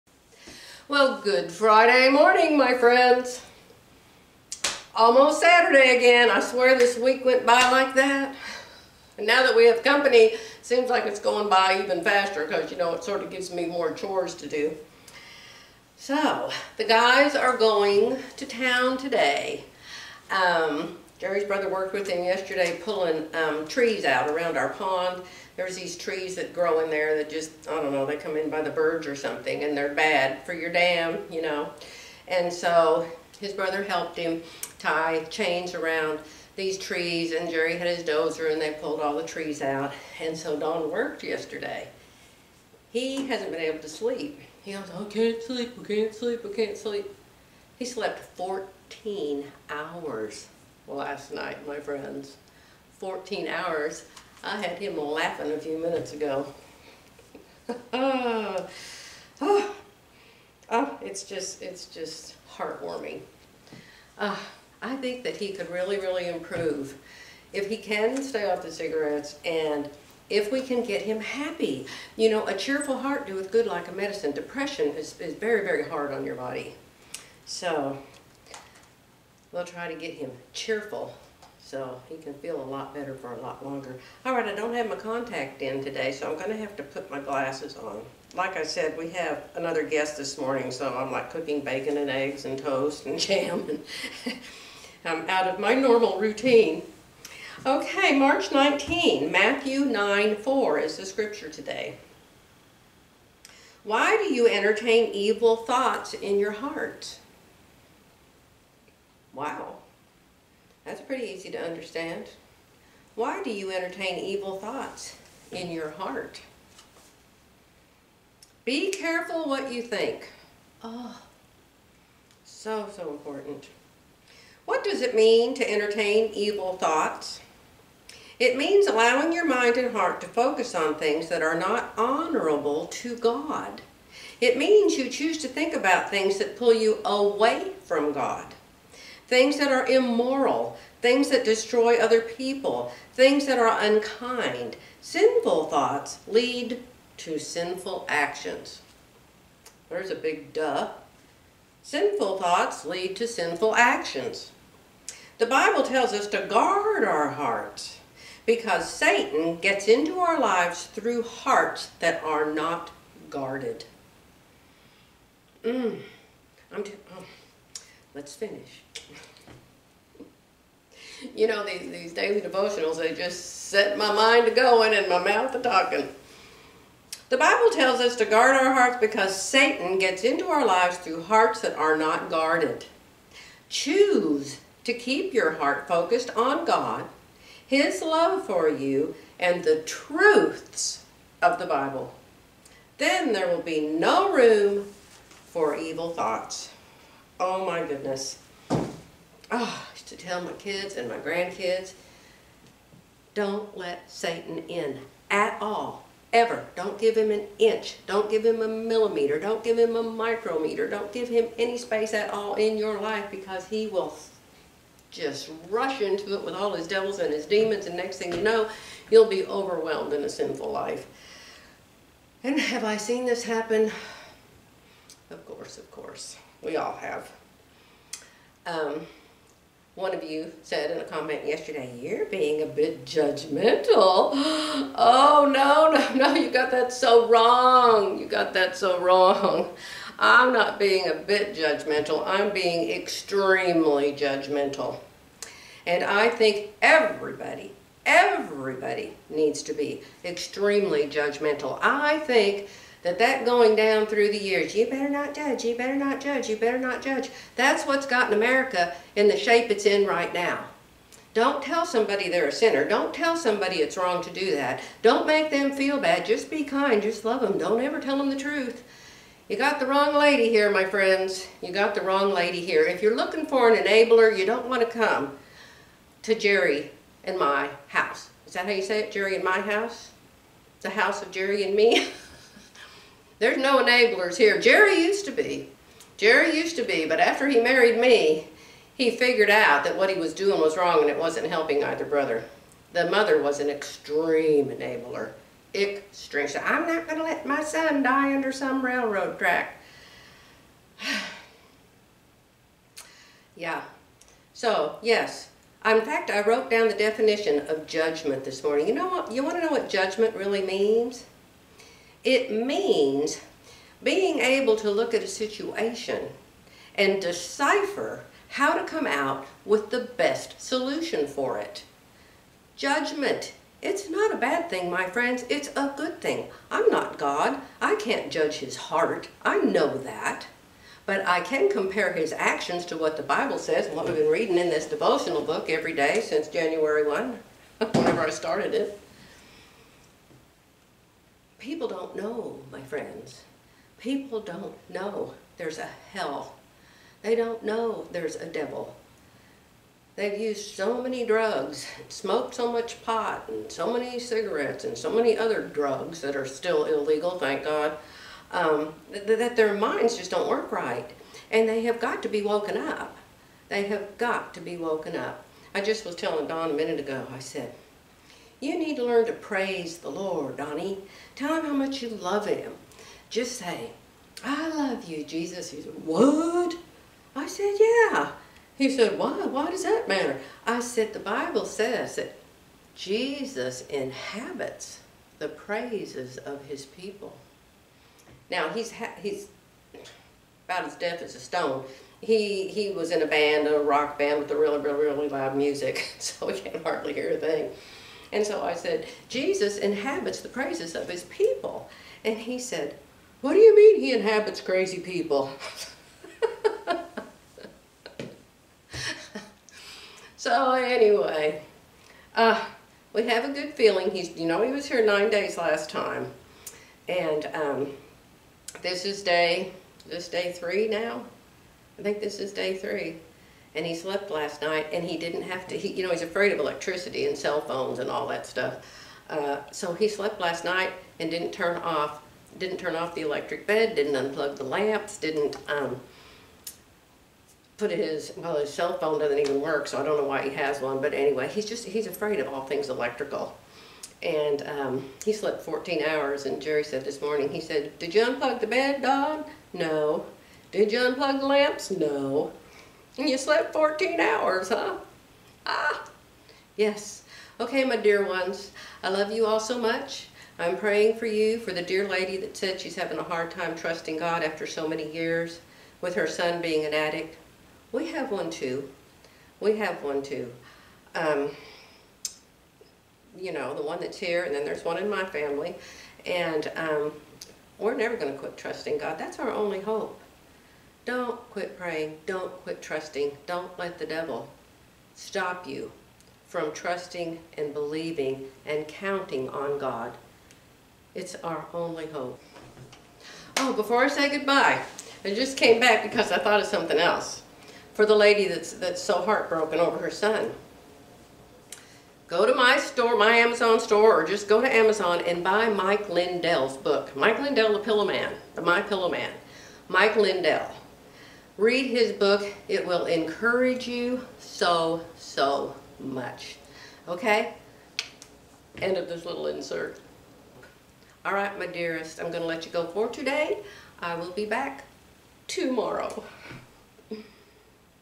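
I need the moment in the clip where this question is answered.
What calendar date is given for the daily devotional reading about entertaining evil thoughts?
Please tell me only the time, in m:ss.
1:38.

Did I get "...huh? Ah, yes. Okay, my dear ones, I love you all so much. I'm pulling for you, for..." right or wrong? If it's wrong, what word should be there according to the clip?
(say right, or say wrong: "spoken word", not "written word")
wrong: "praying", not "pulling".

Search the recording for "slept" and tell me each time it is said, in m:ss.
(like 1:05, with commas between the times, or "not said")
0:47, 7:03, 7:10, 7:25, 7:33.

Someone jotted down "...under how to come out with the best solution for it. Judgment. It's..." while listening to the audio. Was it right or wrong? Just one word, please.
wrong.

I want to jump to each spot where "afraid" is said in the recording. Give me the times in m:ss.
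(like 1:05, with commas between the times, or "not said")
7:06, 7:22.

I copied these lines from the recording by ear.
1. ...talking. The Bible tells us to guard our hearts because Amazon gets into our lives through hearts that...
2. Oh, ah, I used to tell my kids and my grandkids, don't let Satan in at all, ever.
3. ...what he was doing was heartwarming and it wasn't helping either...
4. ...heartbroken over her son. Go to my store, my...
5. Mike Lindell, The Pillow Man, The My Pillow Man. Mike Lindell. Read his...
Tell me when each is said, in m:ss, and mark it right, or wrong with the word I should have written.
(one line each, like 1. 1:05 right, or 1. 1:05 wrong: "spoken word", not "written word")
1. 2:55 wrong: "Satan", not "Amazon"
2. 3:18 right
3. 4:49 wrong: "wrong", not "heartwarming"
4. 8:19 right
5. 8:27 right.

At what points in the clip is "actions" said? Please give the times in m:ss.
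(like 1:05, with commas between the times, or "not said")
2:28, 2:33, 5:32.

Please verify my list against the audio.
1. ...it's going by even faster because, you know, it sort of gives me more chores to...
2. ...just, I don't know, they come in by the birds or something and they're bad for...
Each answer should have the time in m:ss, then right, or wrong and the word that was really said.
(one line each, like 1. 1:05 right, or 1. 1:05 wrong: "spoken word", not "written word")
1. 0:11 right
2. 0:27 right.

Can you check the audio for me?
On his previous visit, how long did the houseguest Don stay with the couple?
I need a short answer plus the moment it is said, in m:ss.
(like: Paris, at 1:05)
9 days, at 6:55.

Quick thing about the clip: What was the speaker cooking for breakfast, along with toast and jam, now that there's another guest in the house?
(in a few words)
Bacon and eggs.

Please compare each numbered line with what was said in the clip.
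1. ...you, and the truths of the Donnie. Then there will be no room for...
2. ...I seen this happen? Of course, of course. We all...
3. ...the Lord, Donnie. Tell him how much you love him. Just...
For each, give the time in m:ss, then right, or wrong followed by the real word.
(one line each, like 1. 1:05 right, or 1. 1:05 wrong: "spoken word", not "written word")
1. 3:08 wrong: "Bible", not "Donnie"
2. 3:42 right
3. 6:09 right.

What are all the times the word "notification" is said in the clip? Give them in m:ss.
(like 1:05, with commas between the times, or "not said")
not said.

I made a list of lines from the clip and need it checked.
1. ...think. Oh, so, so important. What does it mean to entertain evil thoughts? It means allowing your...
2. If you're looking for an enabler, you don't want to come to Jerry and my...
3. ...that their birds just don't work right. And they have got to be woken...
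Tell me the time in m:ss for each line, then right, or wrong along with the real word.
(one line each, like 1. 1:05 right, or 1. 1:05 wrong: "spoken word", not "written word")
1. 1:59 right
2. 4:32 right
3. 5:59 wrong: "minds", not "birds".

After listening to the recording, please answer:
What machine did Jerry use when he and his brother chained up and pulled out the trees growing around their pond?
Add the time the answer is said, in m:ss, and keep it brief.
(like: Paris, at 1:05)
Dozer, at 0:38.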